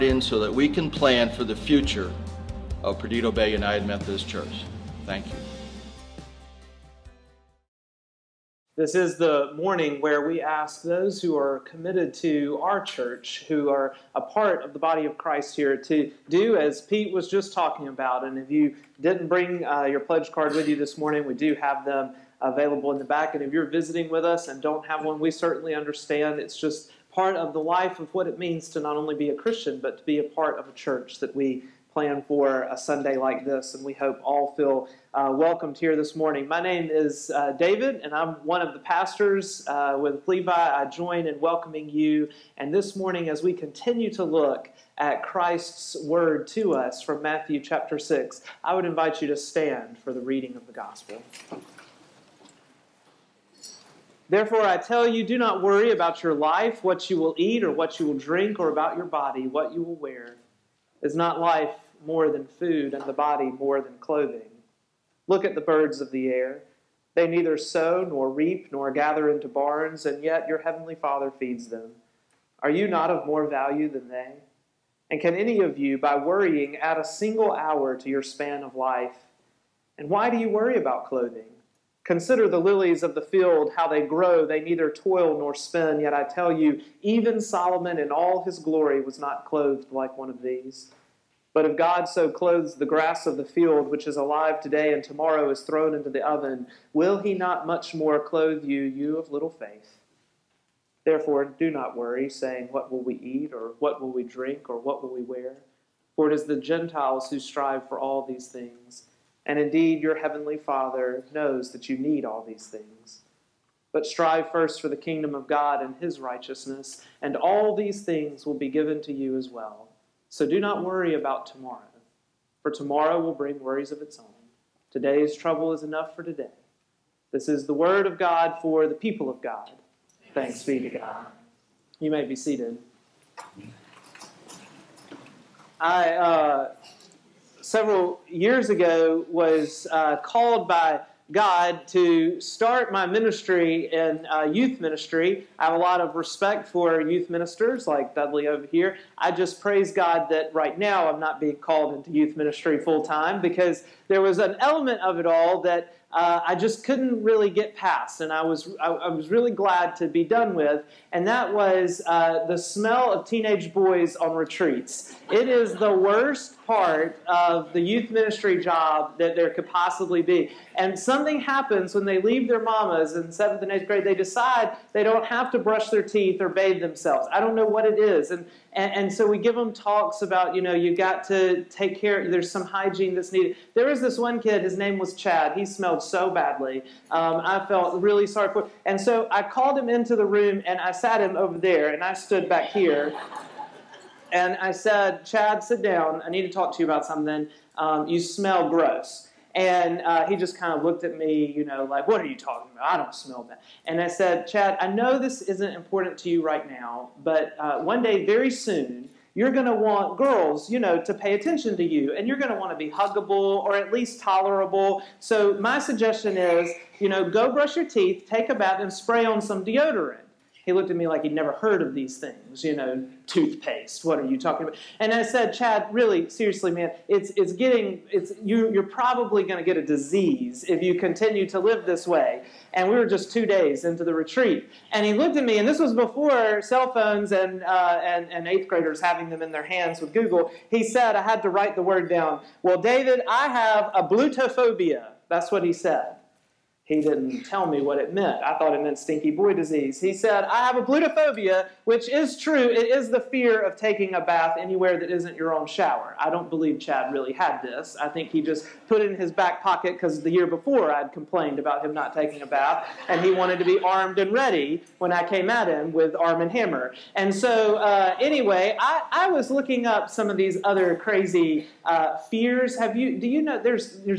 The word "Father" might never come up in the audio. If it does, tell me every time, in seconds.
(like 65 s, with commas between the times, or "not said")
70 s, 110 s.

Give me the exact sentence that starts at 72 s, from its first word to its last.
Are you not of more value than they?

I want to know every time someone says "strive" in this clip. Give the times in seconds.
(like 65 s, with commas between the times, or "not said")
107 s, 114 s.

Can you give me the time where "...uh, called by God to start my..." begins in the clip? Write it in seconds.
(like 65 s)
139 s.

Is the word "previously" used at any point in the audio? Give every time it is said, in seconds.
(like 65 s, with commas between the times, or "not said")
not said.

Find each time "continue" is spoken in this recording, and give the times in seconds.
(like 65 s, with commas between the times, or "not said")
43 s, 230 s.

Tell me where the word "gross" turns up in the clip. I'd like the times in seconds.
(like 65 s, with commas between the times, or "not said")
198 s.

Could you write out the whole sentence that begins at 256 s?
I don't believe Chad really had this.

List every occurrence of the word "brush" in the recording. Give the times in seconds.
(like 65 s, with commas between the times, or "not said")
175 s, 217 s.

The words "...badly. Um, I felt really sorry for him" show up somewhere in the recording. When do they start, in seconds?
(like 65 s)
186 s.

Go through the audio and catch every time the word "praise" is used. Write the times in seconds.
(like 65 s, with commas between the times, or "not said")
149 s.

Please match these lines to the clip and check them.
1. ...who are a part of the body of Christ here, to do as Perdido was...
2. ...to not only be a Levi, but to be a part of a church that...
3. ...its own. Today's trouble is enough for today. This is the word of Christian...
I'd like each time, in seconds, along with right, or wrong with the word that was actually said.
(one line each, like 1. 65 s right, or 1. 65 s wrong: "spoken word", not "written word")
1. 13 s wrong: "Pete", not "Perdido"
2. 28 s wrong: "Christian", not "Levi"
3. 124 s wrong: "God", not "Christian".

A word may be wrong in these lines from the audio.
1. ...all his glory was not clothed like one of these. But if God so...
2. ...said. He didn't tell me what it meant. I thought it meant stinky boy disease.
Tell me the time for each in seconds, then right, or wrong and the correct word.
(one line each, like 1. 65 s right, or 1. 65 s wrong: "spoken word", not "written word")
1. 88 s right
2. 245 s right.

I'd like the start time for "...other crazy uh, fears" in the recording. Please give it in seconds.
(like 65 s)
270 s.